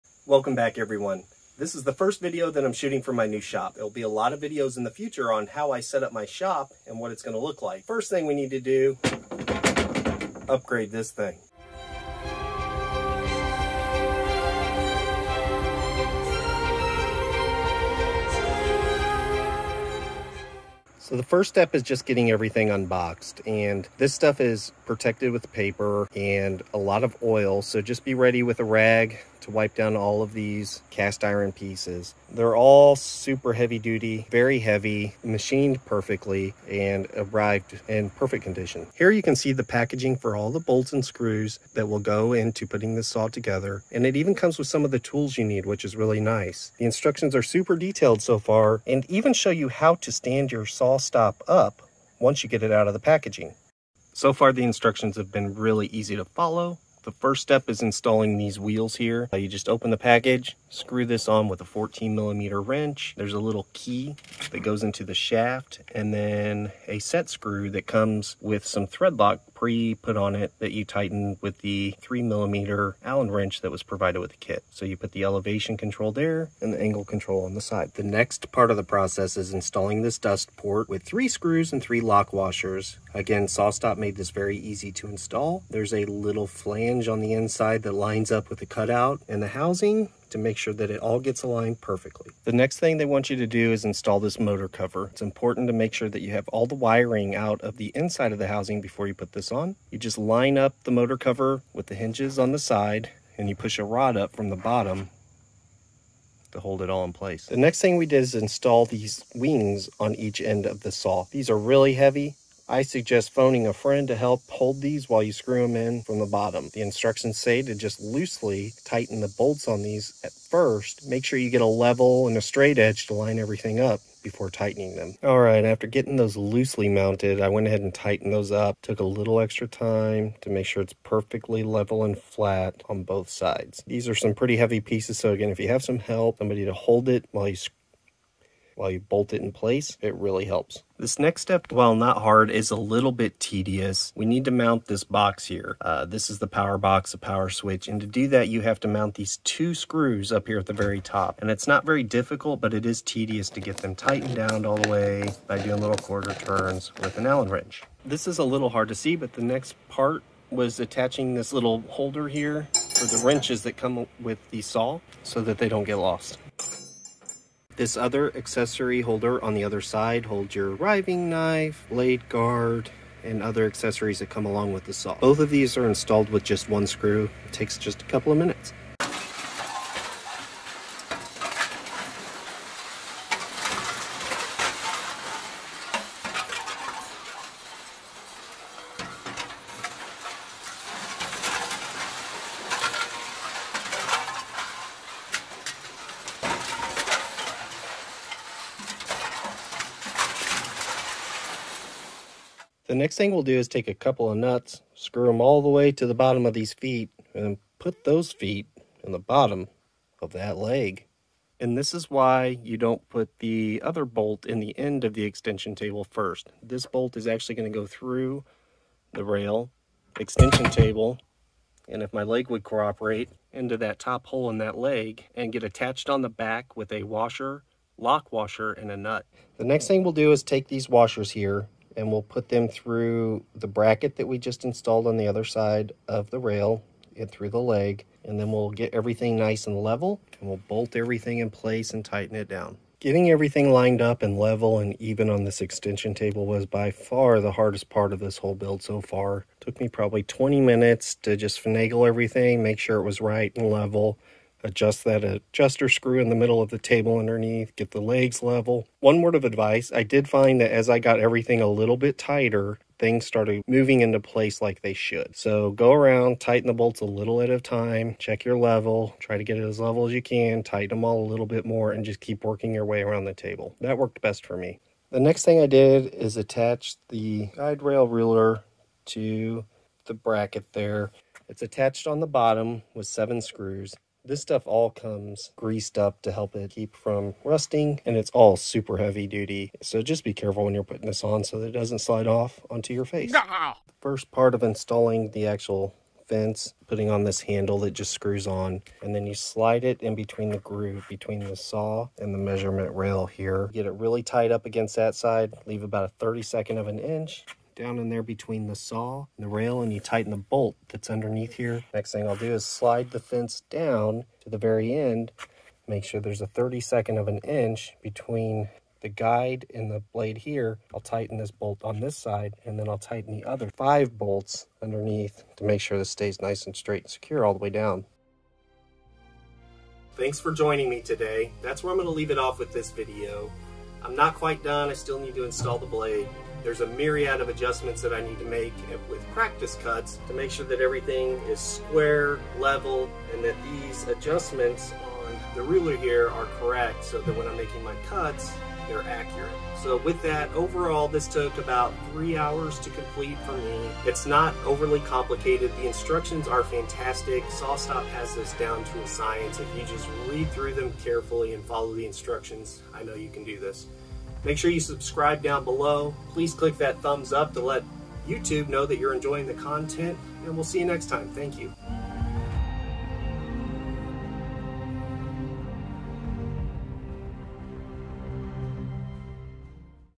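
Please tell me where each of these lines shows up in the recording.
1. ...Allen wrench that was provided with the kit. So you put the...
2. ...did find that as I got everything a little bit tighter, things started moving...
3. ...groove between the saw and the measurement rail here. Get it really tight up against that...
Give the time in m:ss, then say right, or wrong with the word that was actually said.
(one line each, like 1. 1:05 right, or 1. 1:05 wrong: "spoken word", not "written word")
1. 1:13 right
2. 4:20 right
3. 5:00 right.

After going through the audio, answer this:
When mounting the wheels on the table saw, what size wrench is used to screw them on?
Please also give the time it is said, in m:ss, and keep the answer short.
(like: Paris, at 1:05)
14 millimeter, at 1:01.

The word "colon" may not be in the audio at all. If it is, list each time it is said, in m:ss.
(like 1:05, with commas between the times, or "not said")
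not said.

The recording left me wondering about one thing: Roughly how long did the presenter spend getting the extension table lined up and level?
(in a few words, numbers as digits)
20 minutes.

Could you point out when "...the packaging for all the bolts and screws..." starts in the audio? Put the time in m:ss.
0:39.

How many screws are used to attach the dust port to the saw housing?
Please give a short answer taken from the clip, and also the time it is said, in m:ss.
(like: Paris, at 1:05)
3, at 1:21.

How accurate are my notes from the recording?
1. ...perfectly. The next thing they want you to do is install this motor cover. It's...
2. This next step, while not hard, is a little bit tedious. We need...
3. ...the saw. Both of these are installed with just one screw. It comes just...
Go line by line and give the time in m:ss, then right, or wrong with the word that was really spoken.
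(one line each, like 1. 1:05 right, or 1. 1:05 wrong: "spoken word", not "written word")
1. 1:31 right
2. 2:20 right
3. 2:54 wrong: "takes", not "comes".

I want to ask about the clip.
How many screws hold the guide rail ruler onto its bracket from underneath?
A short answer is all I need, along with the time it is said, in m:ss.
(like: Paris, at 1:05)
7, at 4:43.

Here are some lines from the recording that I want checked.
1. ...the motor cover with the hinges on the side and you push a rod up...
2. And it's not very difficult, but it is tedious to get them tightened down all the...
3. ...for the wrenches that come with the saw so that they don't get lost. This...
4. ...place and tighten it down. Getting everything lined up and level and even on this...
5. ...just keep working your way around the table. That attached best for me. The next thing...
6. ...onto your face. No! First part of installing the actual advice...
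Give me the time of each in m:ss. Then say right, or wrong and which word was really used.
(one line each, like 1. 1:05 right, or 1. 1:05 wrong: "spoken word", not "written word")
1. 1:40 right
2. 2:31 right
3. 2:42 right
4. 4:01 right
5. 4:32 wrong: "worked", not "attached"
6. 4:52 wrong: "fence", not "advice".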